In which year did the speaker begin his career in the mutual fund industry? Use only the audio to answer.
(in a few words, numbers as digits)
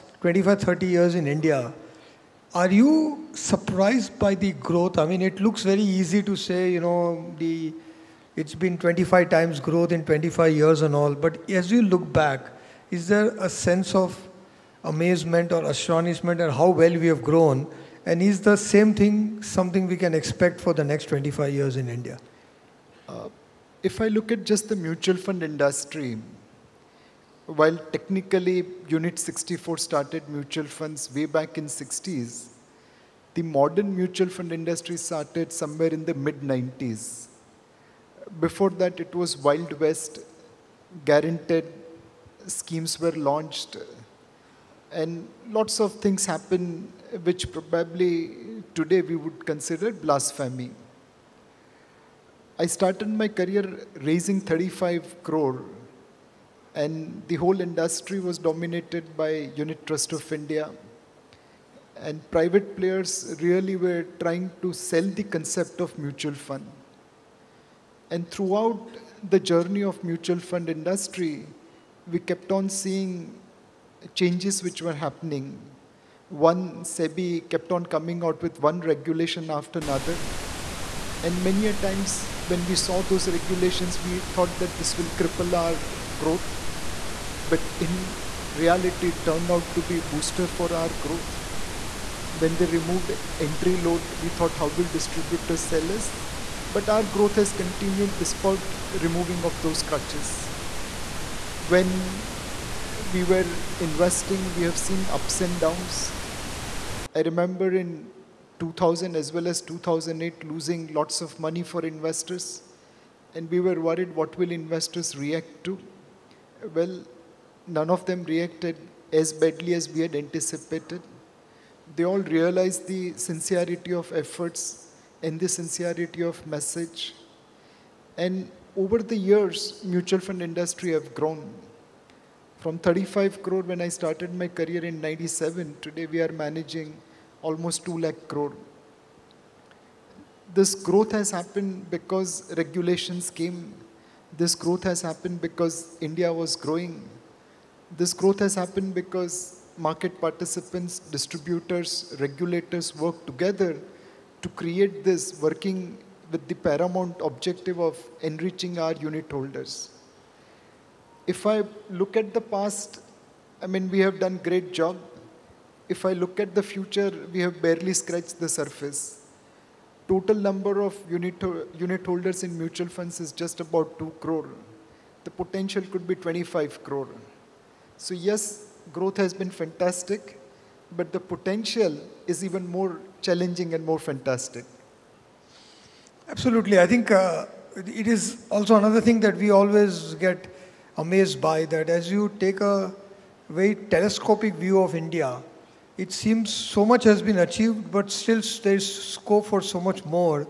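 1997.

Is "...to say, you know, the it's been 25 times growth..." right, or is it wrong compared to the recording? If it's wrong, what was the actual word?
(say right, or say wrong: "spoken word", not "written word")
right.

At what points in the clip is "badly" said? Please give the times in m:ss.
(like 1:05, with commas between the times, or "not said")
1:59.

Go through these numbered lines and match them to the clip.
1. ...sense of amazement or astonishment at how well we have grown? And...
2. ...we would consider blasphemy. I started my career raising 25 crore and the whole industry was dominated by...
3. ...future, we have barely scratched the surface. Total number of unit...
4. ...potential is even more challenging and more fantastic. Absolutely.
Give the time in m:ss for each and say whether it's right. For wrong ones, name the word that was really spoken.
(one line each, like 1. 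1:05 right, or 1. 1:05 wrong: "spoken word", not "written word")
1. 0:13 right
2. 0:49 wrong: "35", not "25"
3. 2:46 right
4. 3:01 right.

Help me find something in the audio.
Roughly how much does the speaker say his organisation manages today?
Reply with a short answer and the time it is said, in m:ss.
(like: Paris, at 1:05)
2 lakh crore, at 2:17.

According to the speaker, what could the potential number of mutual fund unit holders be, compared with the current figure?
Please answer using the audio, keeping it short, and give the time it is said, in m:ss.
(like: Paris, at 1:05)
25 crore, at 2:56.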